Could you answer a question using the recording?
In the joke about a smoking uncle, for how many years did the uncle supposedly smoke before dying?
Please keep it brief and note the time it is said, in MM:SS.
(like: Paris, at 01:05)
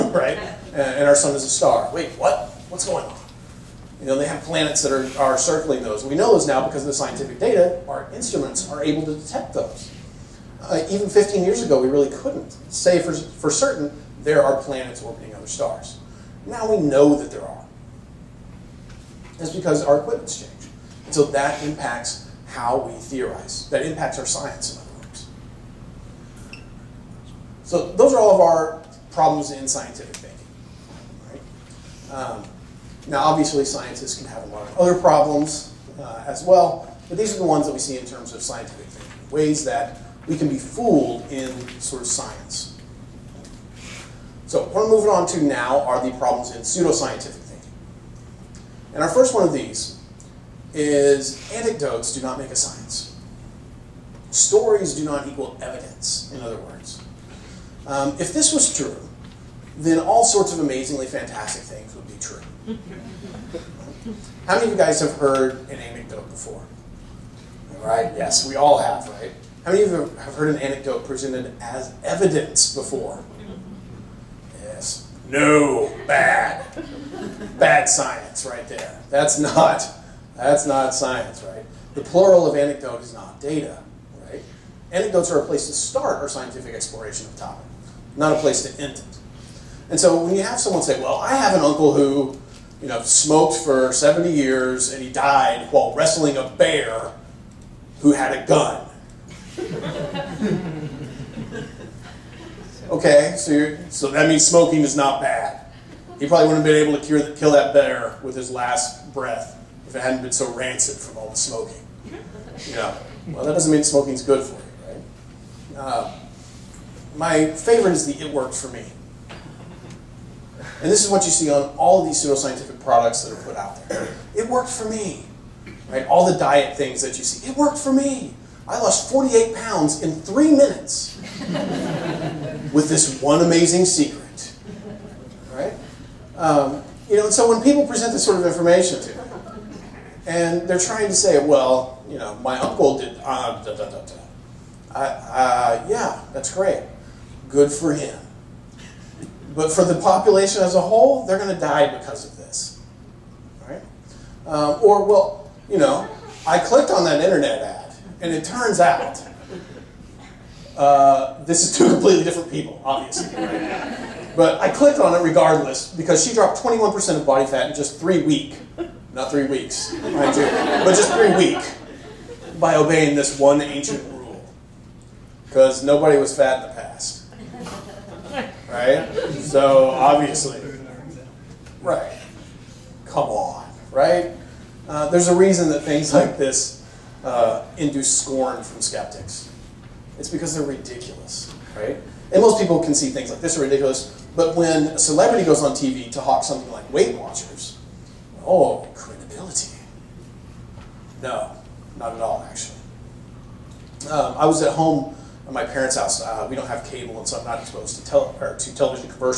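70, at 01:33.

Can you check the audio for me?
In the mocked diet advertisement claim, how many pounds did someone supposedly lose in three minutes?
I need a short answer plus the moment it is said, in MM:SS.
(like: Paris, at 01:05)
48, at 02:09.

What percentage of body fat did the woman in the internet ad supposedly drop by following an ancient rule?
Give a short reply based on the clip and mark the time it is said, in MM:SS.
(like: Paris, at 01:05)
21%, at 02:46.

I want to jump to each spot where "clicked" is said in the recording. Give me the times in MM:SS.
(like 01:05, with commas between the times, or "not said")
02:36, 02:44.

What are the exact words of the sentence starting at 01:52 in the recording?
You know, well, that doesn't mean smoking's good for you, right?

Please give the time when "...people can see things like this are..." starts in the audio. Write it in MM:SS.
03:12.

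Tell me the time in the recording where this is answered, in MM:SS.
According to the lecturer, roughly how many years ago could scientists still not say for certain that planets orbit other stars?
00:11.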